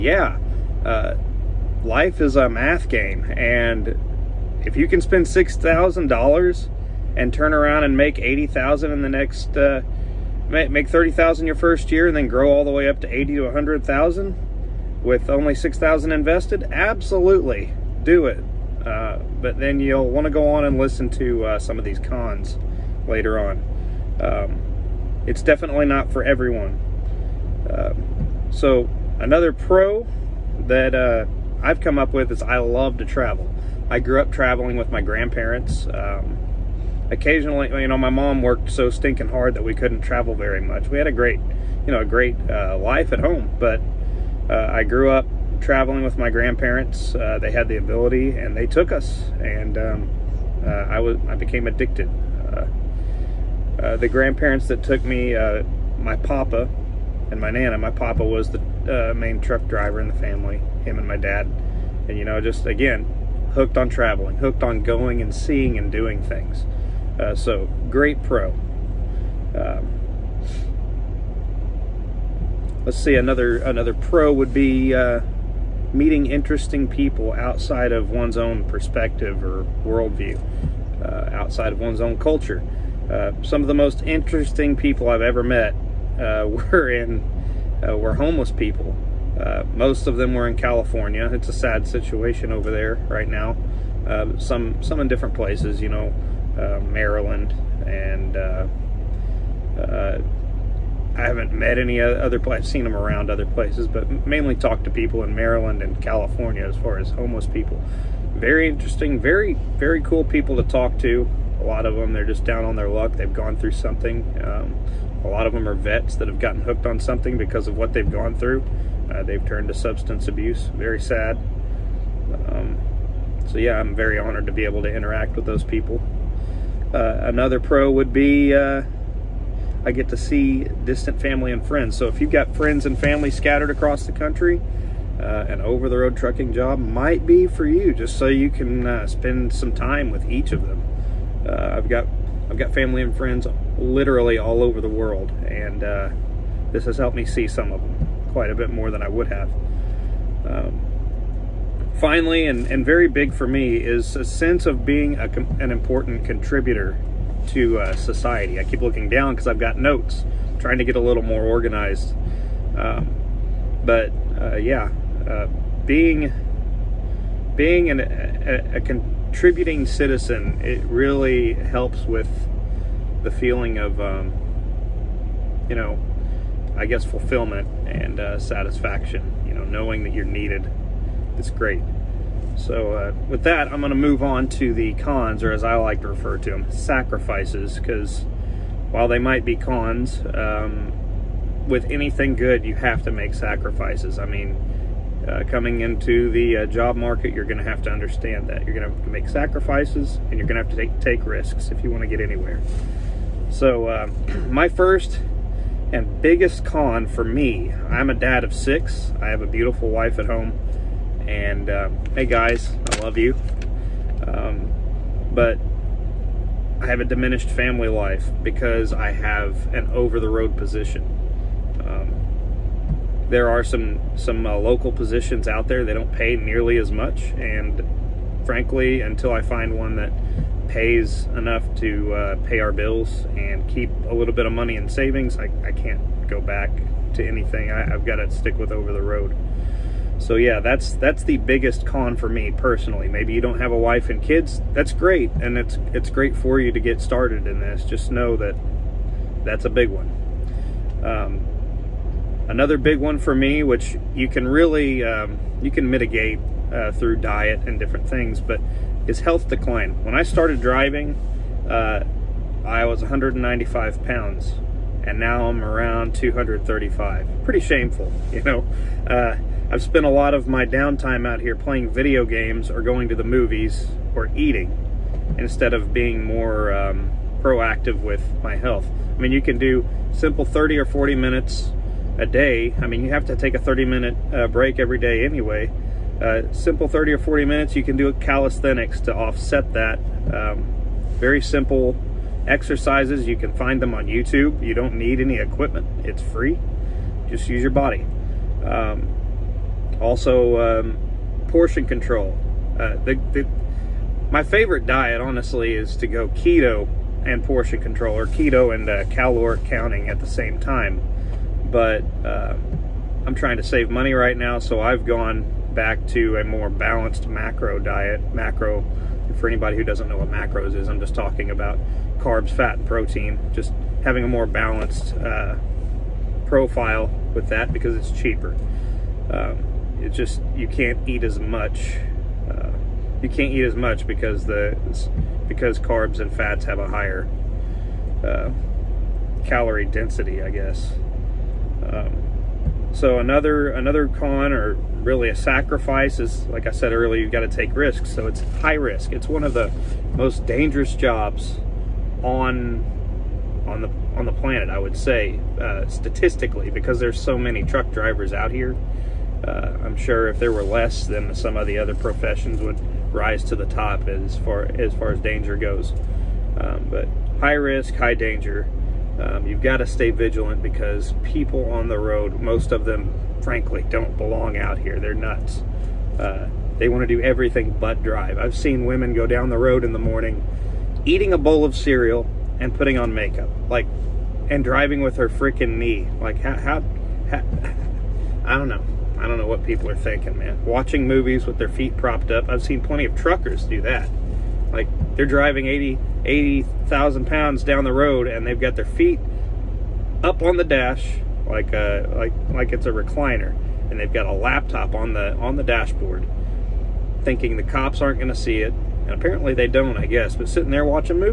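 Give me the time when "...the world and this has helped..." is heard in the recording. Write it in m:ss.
2:24.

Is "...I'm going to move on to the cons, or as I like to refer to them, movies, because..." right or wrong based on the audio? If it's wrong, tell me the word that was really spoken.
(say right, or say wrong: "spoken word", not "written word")
wrong: "sacrifices", not "movies".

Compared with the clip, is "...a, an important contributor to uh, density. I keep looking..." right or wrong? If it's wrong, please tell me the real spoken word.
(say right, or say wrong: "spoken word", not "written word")
wrong: "society", not "density".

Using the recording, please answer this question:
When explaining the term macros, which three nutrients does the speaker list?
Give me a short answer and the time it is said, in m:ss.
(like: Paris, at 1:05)
carbs, fat, and protein, at 5:22.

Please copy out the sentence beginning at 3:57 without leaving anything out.
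I, I've got to stick with over the road.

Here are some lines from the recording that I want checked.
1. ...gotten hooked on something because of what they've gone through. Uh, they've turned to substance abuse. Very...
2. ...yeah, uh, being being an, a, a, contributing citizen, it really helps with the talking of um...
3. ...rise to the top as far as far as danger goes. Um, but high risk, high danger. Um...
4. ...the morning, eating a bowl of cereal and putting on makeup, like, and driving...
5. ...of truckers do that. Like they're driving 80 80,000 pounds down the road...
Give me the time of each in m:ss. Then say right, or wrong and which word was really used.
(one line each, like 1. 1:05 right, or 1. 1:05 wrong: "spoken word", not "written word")
1. 1:56 right
2. 2:44 wrong: "feeling", not "talking"
3. 6:03 right
4. 6:19 right
5. 6:33 right.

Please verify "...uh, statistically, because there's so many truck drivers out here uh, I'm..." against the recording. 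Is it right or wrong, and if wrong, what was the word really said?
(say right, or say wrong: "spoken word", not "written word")
right.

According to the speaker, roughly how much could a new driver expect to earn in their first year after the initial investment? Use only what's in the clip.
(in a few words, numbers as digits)
$30,000.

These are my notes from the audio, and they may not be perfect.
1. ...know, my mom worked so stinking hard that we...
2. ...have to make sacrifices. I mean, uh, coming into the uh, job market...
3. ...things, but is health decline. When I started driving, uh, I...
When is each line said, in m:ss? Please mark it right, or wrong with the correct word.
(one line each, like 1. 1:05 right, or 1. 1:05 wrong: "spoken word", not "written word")
1. 0:37 right
2. 3:12 right
3. 4:18 right.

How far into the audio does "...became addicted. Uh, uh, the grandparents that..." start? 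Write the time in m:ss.
0:51.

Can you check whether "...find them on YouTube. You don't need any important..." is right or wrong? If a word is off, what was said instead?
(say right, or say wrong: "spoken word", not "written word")
wrong: "equipment", not "important".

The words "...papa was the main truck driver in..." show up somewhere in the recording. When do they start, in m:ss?
0:57.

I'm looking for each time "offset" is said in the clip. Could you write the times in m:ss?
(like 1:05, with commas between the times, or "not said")
4:49.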